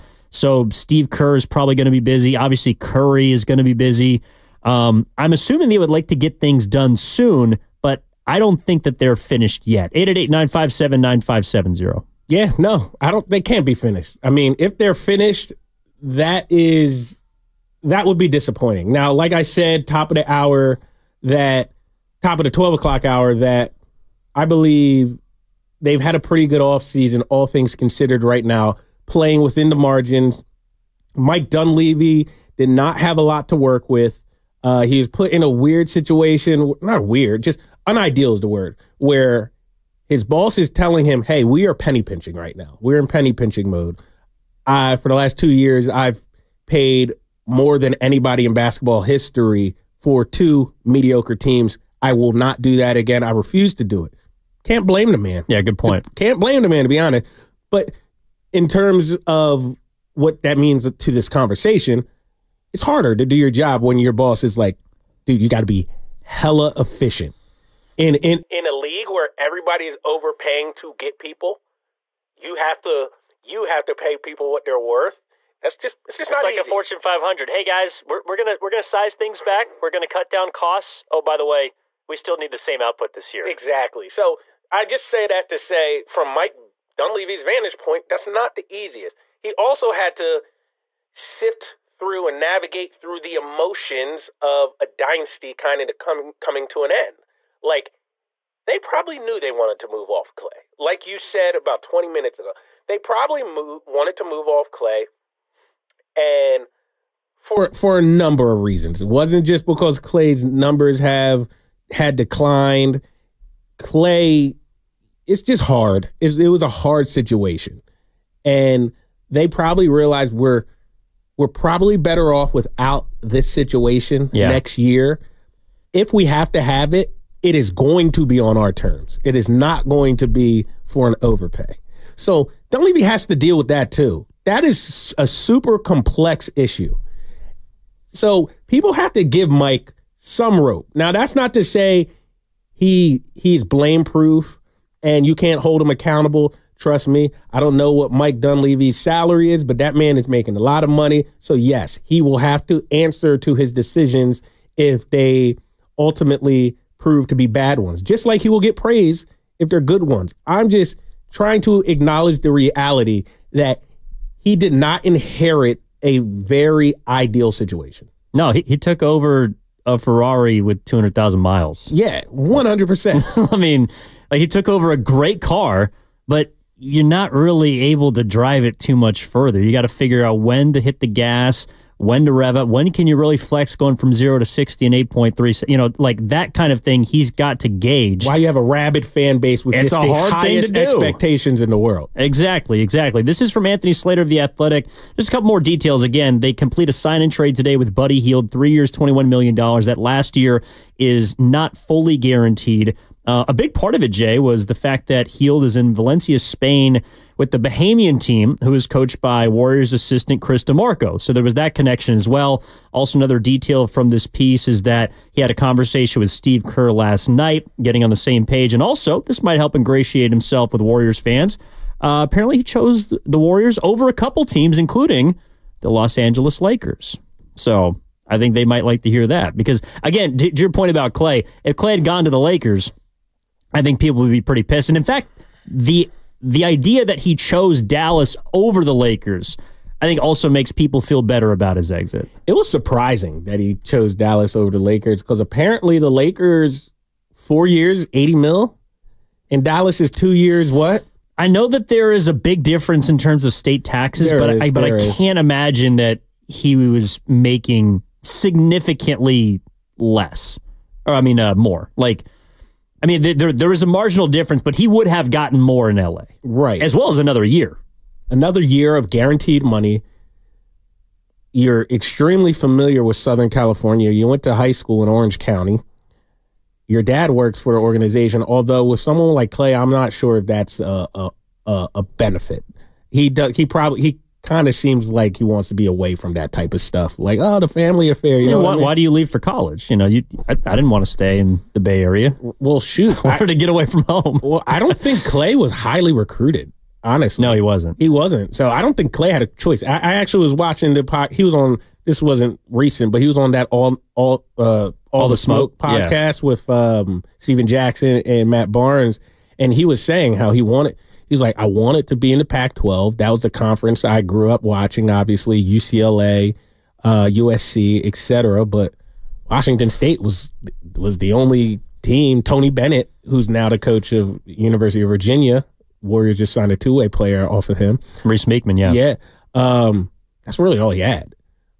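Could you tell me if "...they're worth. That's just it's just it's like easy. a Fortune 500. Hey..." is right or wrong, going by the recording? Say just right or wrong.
right.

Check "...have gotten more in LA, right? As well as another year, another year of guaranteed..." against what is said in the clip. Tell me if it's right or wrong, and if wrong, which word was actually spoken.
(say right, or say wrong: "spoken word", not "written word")
right.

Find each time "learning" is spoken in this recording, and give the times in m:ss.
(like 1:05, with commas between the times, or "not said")
not said.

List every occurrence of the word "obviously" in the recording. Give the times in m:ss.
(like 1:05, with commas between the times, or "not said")
0:02, 5:15.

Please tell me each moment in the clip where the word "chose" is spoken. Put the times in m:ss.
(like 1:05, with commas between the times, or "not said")
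3:42, 3:57, 4:03.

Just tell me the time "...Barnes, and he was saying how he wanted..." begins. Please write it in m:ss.
5:08.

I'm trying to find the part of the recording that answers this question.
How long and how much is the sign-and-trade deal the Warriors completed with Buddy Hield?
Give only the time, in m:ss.
3:18.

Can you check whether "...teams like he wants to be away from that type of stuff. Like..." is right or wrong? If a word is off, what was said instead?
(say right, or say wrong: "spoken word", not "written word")
wrong: "seems", not "teams".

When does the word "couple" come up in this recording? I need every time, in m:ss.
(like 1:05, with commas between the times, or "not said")
3:15, 3:44.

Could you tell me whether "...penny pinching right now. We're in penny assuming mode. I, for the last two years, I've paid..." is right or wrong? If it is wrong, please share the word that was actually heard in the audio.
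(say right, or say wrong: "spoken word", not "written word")
wrong: "pinching", not "assuming".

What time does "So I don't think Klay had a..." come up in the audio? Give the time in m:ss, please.
4:58.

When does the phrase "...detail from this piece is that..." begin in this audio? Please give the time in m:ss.
3:33.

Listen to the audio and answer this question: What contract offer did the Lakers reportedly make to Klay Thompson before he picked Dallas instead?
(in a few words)
4 years, $80 million.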